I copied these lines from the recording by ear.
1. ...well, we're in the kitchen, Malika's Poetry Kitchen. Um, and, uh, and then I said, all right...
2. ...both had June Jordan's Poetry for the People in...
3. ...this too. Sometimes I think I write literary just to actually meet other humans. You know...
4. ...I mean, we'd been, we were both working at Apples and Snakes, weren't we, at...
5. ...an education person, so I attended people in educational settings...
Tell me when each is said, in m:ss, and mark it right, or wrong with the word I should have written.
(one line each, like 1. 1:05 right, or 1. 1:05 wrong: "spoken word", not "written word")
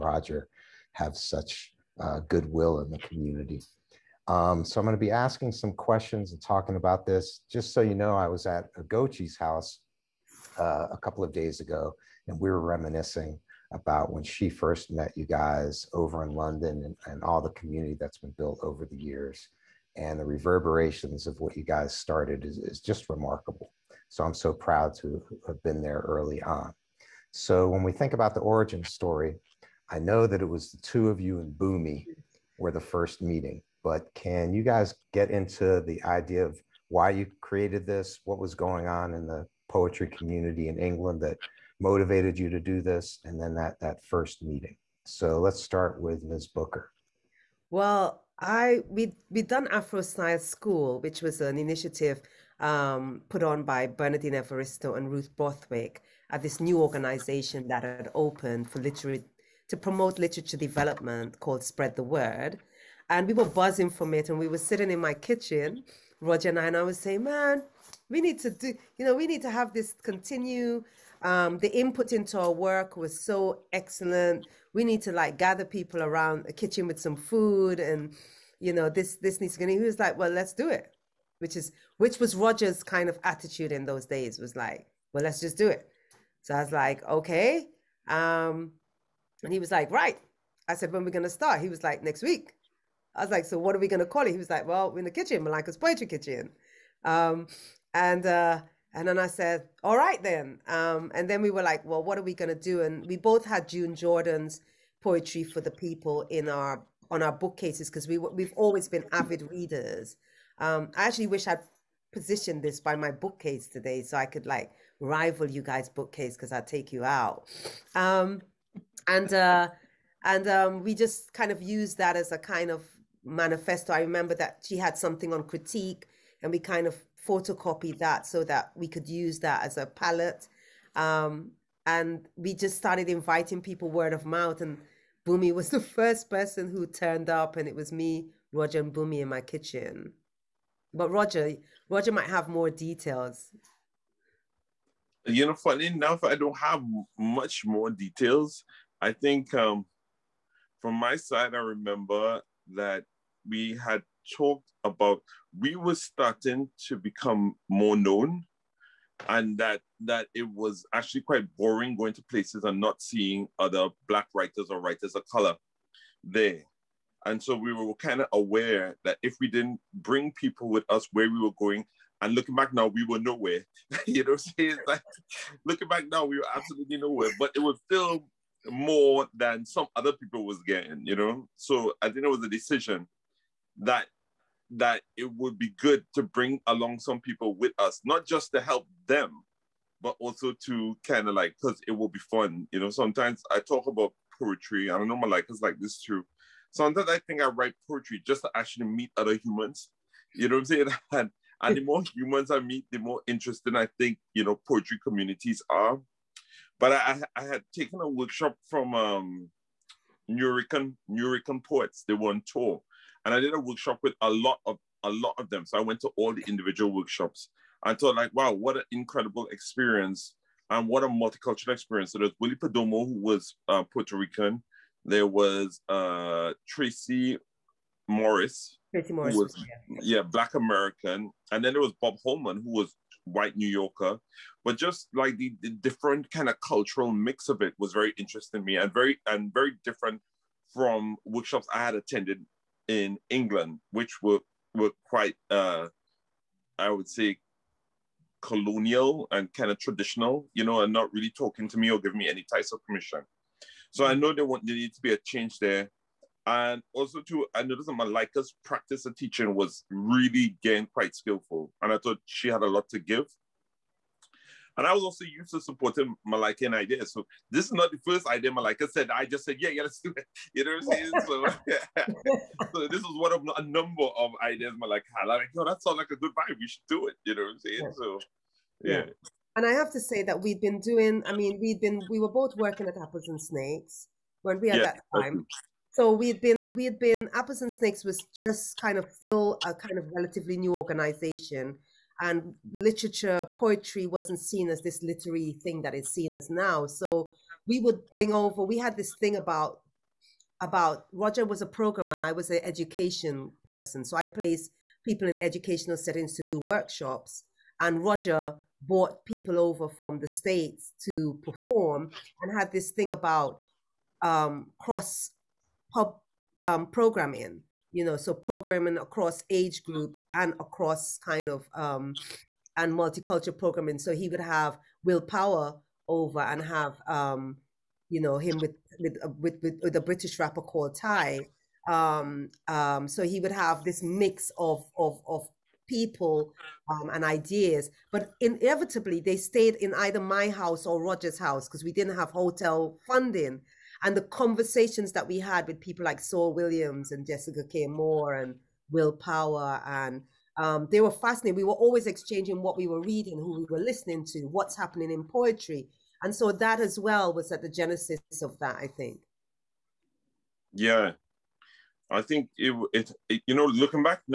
1. 1:34 right
2. 1:43 right
3. 3:15 wrong: "poetry", not "literary"
4. 4:41 right
5. 5:02 wrong: "placed", not "attended".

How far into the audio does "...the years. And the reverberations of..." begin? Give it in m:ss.
0:18.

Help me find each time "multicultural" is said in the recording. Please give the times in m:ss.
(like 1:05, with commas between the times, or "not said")
3:41, 5:22.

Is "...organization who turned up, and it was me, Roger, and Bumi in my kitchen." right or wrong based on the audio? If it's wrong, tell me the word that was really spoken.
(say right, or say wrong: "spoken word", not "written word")
wrong: "person", not "organization".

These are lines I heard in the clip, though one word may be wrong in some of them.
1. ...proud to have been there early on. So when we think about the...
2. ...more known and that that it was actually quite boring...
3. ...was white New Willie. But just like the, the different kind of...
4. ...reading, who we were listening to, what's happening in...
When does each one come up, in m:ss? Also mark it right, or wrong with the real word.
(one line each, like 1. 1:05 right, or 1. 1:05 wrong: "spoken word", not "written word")
1. 0:24 right
2. 2:37 right
3. 3:52 wrong: "Yorker", not "Willie"
4. 5:53 right.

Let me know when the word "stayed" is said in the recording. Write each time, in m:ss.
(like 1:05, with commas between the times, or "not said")
5:39.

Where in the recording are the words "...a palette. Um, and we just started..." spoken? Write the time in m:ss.
2:09.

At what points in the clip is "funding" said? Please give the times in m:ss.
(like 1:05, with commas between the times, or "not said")
5:43.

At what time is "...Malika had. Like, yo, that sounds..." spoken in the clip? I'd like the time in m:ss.
4:34.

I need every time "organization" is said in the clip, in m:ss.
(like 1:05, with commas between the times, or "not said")
0:56, 4:50.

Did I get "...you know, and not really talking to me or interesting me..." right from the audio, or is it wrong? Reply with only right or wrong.
wrong.